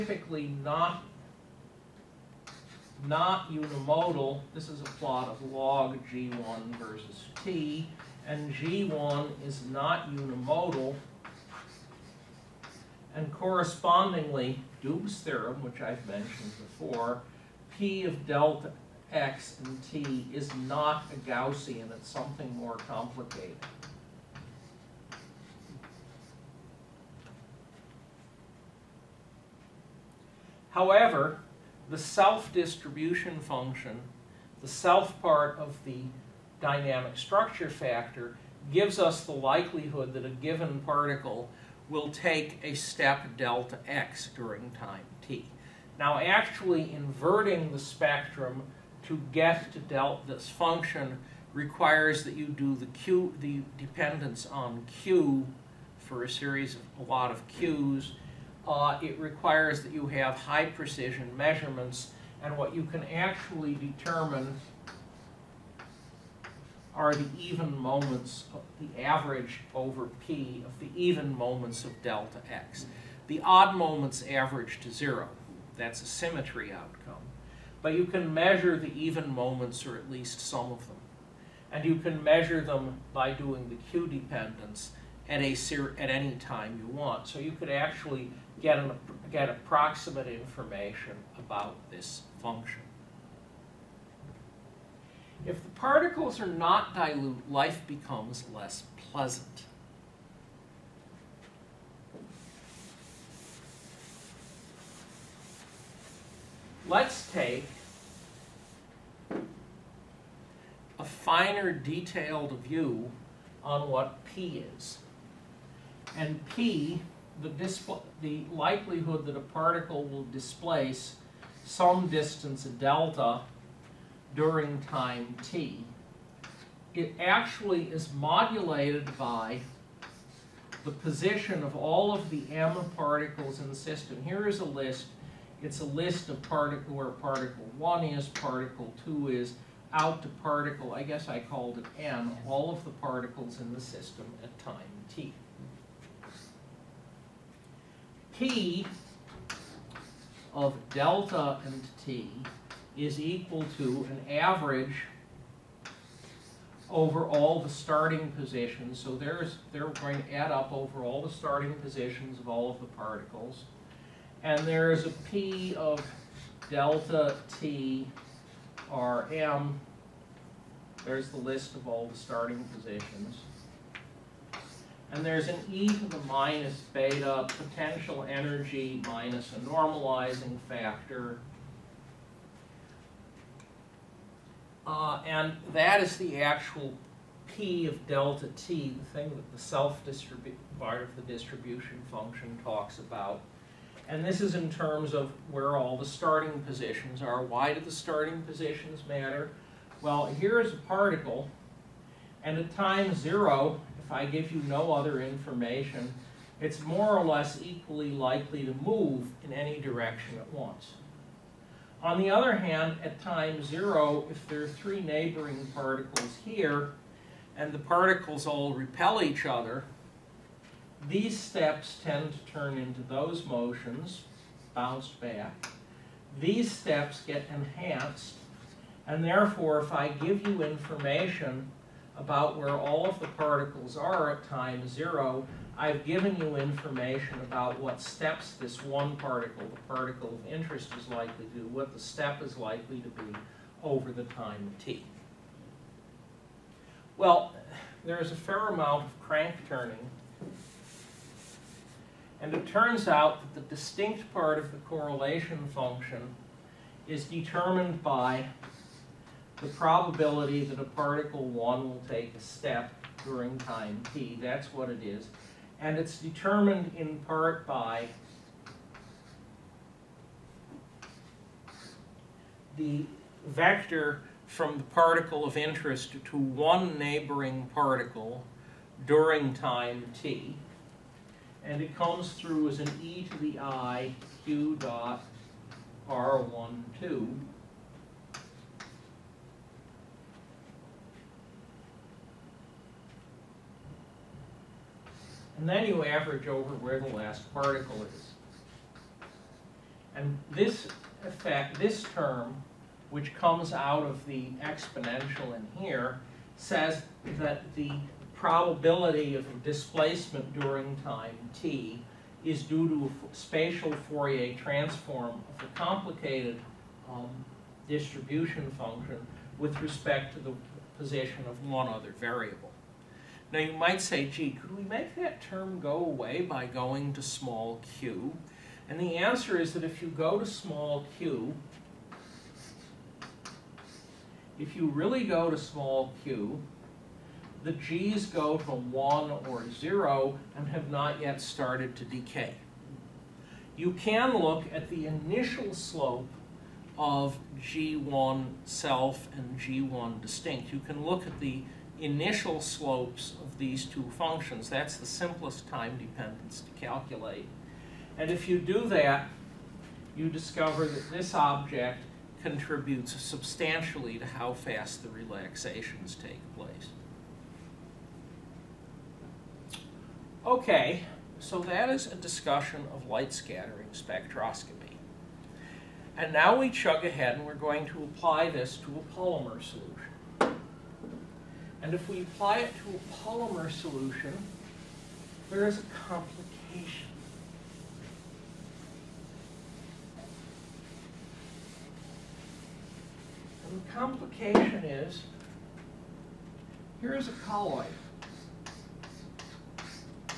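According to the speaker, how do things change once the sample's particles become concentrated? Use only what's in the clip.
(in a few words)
Life becomes less pleasant.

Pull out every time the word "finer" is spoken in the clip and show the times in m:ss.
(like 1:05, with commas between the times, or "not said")
1:51.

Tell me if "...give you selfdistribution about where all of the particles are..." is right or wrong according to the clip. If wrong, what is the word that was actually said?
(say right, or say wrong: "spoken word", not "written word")
wrong: "information", not "selfdistribution".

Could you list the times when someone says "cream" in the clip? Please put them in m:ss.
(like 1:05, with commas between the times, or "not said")
not said.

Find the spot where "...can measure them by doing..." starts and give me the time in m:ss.
1:21.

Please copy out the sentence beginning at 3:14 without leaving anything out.
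And this is in terms of where all the starting positions are.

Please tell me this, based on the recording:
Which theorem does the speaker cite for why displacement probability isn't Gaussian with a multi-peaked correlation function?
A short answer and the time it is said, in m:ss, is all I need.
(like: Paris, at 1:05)
Doob's theorem, at 0:14.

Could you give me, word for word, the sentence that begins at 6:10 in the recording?
Okay, so that is a discussion of light scattering spectroscopy.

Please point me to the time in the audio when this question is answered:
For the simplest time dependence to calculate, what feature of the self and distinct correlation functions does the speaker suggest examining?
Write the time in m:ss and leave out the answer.
5:51.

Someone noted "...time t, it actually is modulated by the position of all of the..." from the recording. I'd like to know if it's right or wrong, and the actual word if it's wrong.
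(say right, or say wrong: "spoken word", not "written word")
right.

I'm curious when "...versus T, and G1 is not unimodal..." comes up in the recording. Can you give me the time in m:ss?
0:06.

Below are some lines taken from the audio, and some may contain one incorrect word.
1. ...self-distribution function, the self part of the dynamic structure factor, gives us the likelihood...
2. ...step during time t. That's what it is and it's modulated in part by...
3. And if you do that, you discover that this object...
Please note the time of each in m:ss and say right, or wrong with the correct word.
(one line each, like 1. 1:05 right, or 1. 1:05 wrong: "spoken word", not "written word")
1. 0:31 right
2. 4:22 wrong: "determined", not "modulated"
3. 5:58 right.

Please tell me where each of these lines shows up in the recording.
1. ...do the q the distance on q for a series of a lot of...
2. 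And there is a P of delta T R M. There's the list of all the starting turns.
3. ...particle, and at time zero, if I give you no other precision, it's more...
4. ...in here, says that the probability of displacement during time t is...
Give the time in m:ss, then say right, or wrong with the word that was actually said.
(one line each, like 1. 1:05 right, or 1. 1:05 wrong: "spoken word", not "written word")
1. 0:52 wrong: "dependence", not "distance"
2. 2:44 wrong: "positions", not "turns"
3. 3:20 wrong: "information", not "precision"
4. 5:05 right.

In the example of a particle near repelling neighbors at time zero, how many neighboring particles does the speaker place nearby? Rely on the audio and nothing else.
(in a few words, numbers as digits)
3.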